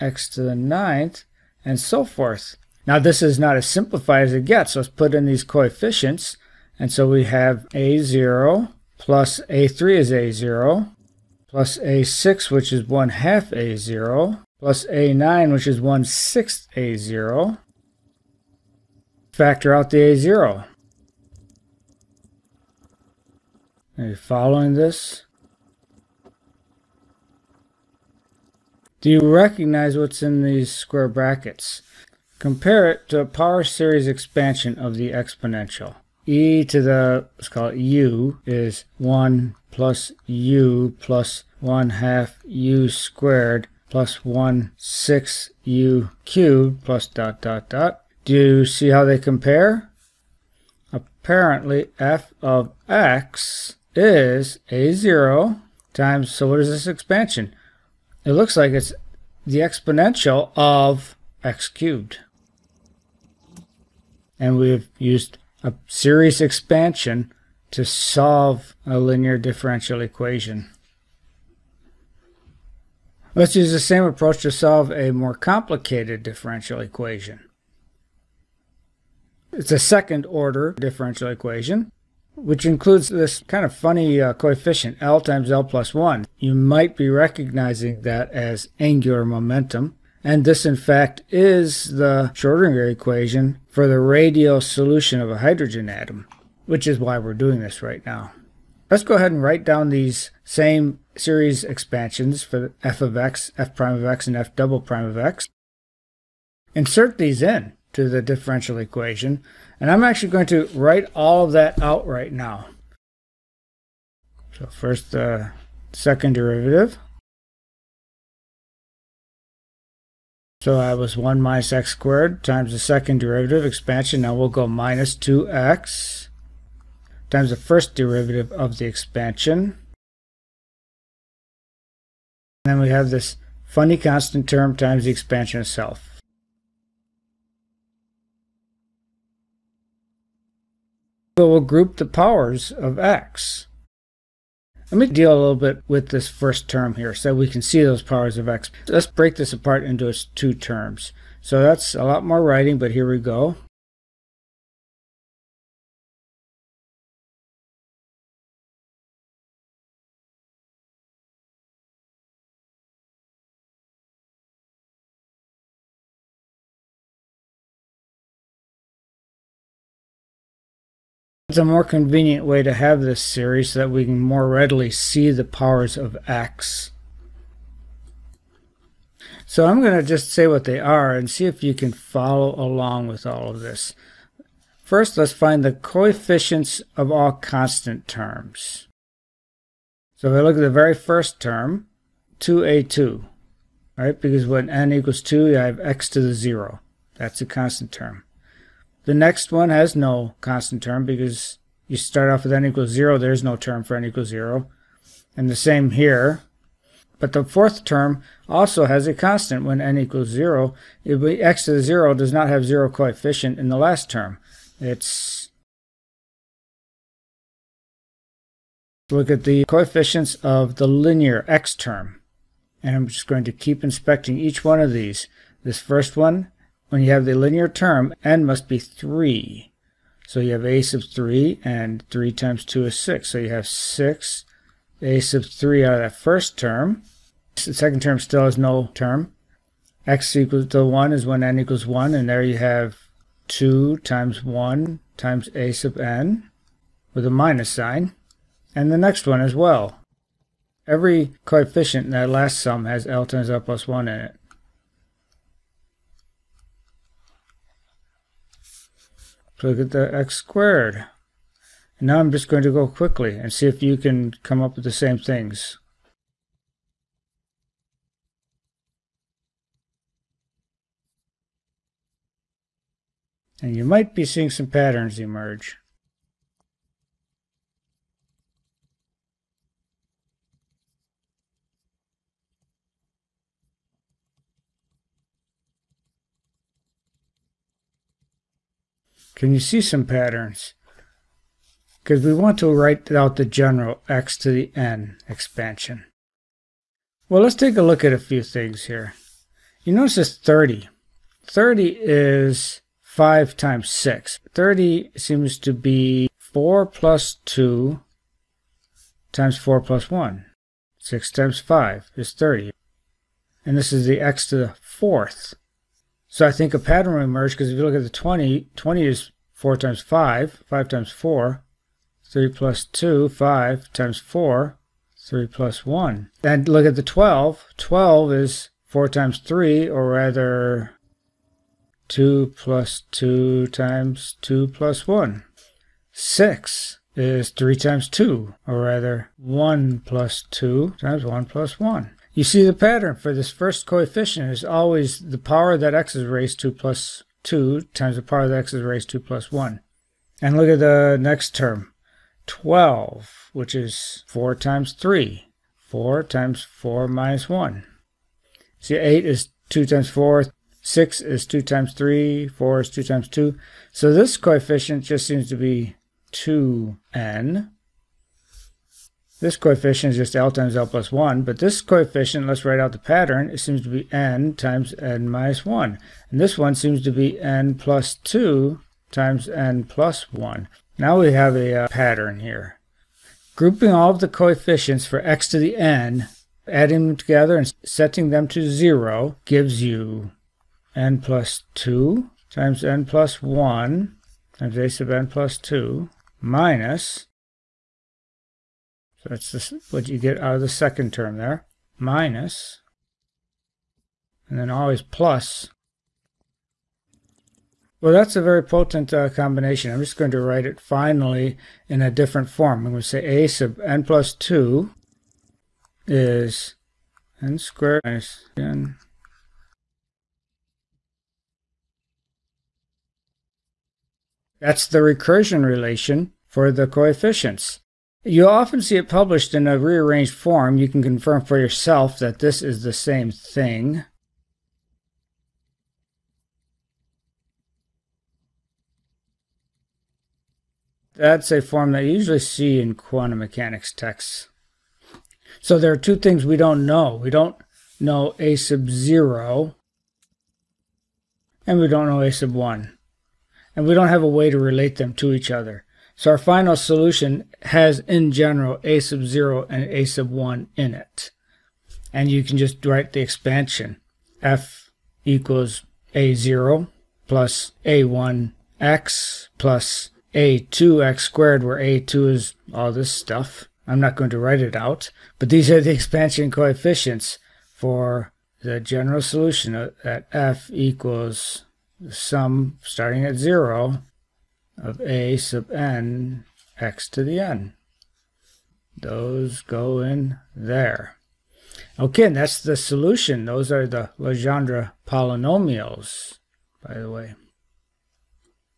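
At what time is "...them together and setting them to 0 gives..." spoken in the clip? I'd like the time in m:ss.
6:27.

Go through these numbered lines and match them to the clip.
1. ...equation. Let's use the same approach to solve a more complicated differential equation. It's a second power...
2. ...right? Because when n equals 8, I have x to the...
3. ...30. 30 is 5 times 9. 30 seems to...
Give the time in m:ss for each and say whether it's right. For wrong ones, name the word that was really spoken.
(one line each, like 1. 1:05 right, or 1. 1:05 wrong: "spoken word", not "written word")
1. 1:10 wrong: "order", not "power"
2. 3:13 wrong: "2", not "8"
3. 5:00 wrong: "6", not "9".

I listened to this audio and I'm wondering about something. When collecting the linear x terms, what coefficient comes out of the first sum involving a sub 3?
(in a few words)
6 a sub 3.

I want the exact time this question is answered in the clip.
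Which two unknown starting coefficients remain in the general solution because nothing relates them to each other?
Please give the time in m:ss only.
7:28.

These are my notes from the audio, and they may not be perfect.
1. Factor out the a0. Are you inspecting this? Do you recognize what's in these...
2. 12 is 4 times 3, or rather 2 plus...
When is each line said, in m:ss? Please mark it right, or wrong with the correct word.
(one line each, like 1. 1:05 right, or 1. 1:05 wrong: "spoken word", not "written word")
1. 0:19 wrong: "following", not "inspecting"
2. 5:27 right.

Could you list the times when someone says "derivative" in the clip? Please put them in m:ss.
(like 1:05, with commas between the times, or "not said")
1:56, 2:03, 2:07.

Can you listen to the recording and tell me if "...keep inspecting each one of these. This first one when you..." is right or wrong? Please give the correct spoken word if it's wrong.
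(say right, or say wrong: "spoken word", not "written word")
right.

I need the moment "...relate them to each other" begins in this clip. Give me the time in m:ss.
7:34.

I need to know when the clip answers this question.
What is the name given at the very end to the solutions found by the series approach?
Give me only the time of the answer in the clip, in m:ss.
8:14.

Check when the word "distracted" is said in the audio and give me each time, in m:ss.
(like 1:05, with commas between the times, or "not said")
not said.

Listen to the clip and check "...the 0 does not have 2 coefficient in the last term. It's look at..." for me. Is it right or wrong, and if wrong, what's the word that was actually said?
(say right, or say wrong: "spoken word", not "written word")
wrong: "0", not "2".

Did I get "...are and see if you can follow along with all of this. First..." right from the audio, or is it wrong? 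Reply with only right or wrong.
right.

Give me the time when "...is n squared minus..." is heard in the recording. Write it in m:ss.
6:56.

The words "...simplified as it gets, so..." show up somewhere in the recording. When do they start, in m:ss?
0:03.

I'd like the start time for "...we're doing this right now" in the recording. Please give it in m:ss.
1:37.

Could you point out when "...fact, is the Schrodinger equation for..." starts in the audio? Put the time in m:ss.
1:30.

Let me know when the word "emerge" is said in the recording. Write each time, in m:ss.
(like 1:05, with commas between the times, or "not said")
4:35, 5:17.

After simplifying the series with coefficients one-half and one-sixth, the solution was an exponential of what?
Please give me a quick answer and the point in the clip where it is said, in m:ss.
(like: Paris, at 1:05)
x cubed, at 1:00.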